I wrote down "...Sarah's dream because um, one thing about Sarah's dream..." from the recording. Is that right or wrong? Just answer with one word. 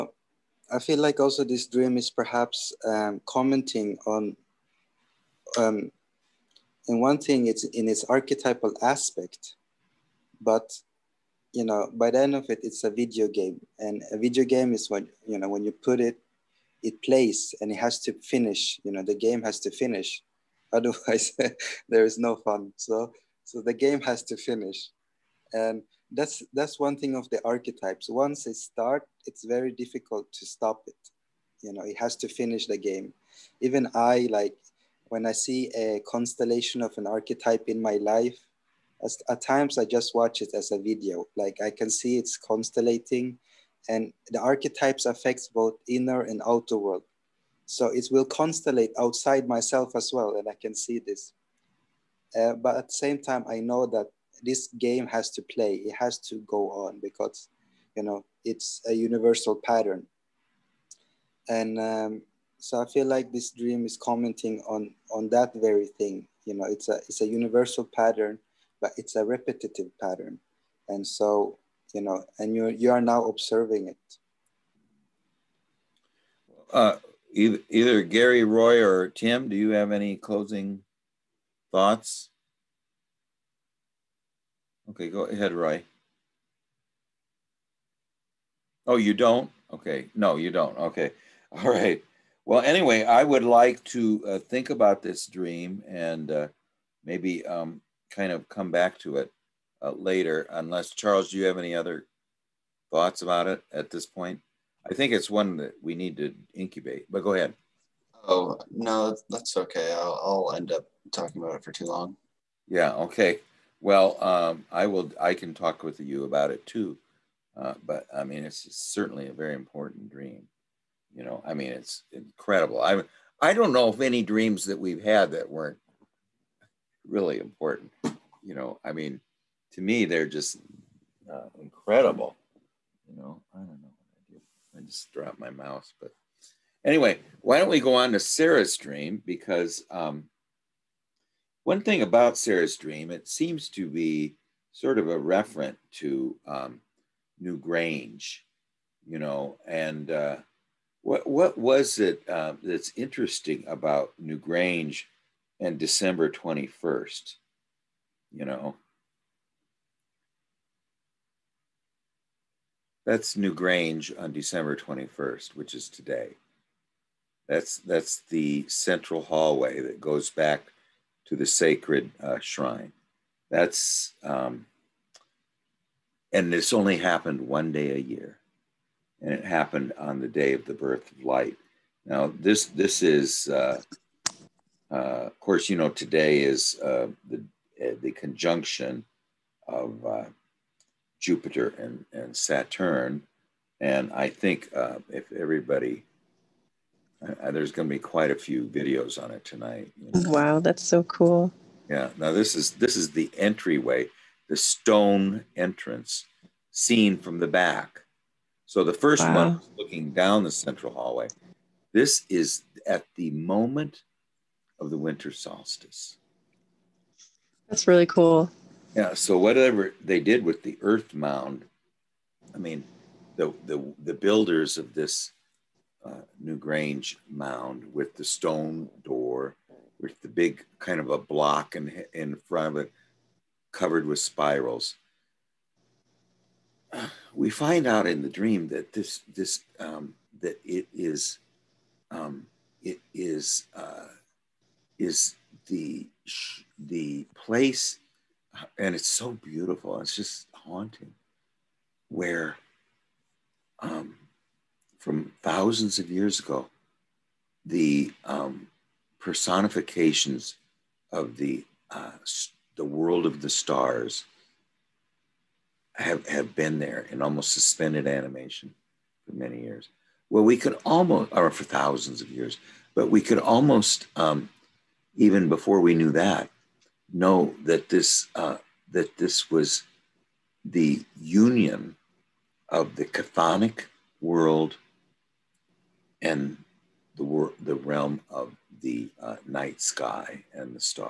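right.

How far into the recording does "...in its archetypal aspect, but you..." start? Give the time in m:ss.
0:07.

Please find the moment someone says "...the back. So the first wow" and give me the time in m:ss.
3:27.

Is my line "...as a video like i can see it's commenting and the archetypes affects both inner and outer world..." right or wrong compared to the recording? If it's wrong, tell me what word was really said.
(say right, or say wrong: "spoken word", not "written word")
wrong: "constellating", not "commenting".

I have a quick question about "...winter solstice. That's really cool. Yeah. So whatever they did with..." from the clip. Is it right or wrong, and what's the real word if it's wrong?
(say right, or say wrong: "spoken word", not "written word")
right.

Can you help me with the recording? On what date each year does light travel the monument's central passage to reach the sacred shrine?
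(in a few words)
December 21st.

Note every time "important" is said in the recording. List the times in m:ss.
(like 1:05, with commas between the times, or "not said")
1:59, 2:07.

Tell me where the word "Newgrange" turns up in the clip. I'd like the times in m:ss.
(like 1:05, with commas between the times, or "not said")
2:27, 2:34, 2:43, 3:46.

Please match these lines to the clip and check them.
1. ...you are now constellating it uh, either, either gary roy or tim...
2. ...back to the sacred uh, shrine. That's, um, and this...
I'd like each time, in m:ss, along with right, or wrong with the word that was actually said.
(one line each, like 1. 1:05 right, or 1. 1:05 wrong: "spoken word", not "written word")
1. 1:12 wrong: "observing", not "constellating"
2. 2:50 right.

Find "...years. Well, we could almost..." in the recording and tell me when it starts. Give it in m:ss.
4:29.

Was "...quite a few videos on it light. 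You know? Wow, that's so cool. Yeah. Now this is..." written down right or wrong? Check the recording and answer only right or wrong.
wrong.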